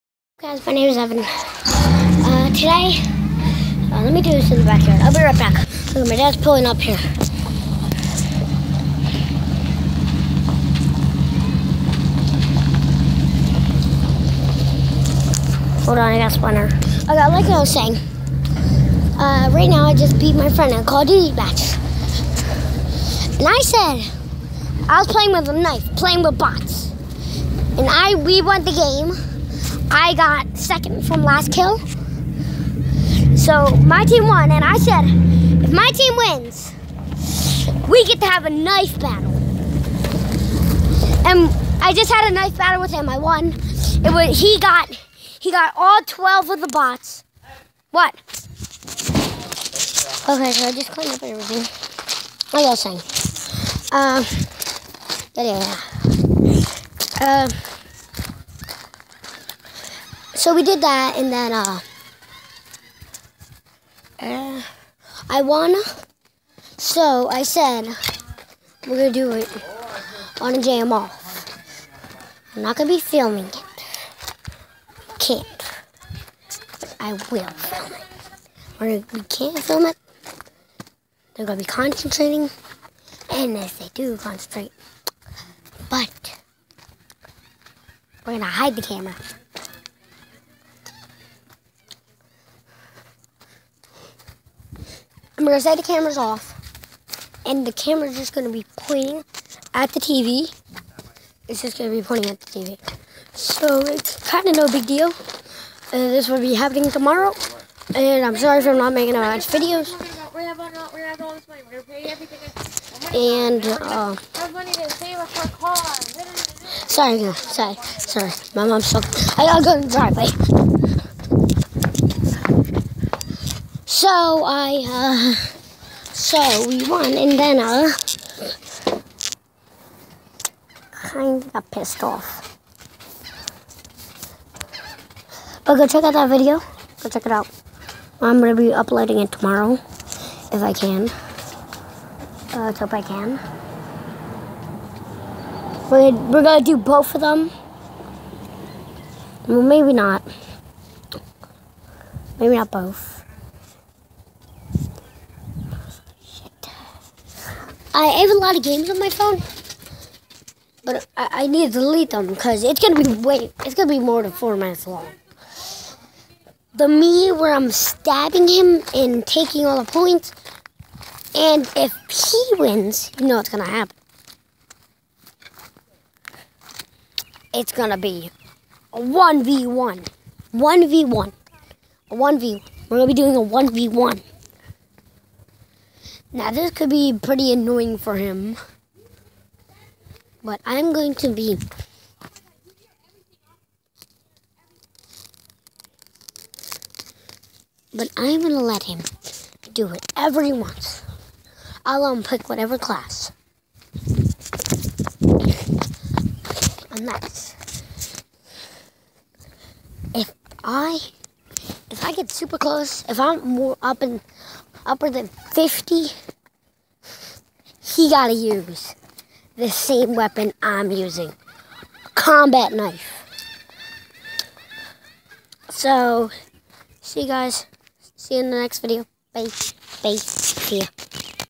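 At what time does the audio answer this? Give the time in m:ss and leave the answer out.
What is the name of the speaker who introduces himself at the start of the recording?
0:00.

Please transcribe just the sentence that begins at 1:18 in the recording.
Or we can't film it, they're going to be concentrating.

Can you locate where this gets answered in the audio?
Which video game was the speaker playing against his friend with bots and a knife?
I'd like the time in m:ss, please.
0:20.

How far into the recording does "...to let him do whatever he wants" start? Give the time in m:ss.
3:18.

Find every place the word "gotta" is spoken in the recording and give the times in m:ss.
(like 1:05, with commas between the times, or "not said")
1:59, 3:38.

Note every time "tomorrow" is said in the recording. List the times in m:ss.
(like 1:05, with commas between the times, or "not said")
1:46, 2:19.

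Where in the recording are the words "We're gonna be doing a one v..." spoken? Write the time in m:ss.
3:02.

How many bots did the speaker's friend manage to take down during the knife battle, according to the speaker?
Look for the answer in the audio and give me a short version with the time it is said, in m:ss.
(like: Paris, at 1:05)
12, at 0:46.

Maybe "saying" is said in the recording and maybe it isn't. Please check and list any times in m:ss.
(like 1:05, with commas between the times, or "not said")
0:17, 0:53.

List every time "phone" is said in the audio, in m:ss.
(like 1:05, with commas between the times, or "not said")
2:39.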